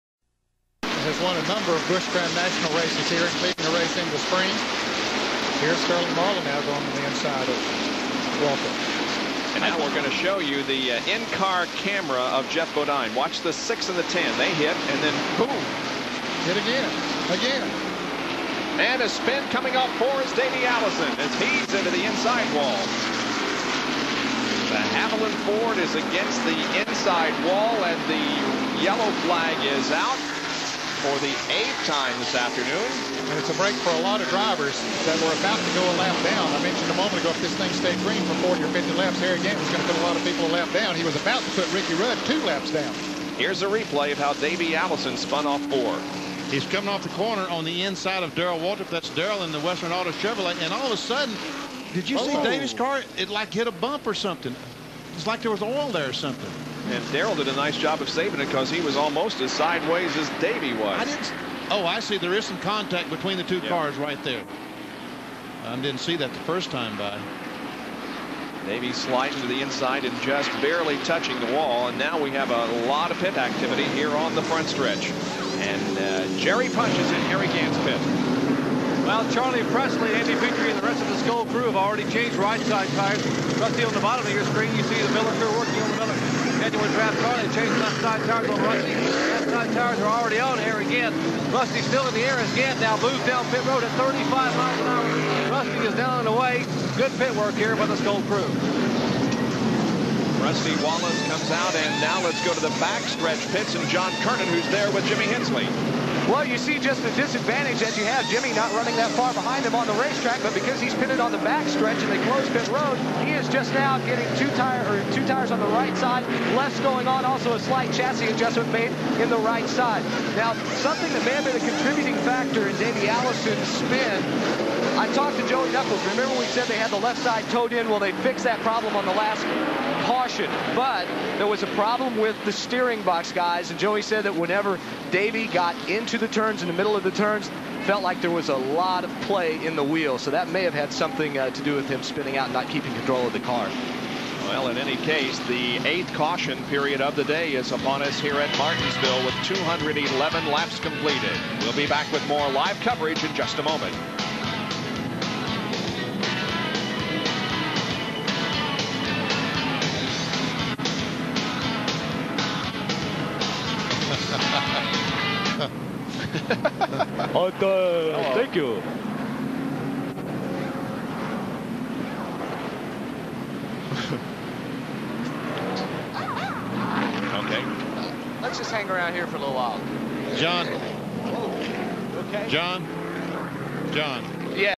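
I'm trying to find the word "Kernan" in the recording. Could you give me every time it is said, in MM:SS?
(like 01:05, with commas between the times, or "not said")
01:44.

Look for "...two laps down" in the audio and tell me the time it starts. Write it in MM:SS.
00:42.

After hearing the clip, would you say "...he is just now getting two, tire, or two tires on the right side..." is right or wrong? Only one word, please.
right.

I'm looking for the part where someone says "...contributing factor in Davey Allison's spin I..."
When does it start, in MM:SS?
02:01.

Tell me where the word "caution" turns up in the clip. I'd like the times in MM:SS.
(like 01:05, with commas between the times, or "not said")
02:10, 02:26.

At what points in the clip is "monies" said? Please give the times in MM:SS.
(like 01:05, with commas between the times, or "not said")
not said.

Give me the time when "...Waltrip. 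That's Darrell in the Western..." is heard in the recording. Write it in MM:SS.
00:48.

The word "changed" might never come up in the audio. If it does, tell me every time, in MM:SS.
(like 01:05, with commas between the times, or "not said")
01:22, 01:27.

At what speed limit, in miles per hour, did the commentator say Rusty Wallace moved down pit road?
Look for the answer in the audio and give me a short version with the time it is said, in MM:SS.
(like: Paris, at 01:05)
35, at 01:33.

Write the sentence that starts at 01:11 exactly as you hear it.
And now we have a lot of pit activity here on the front stretch.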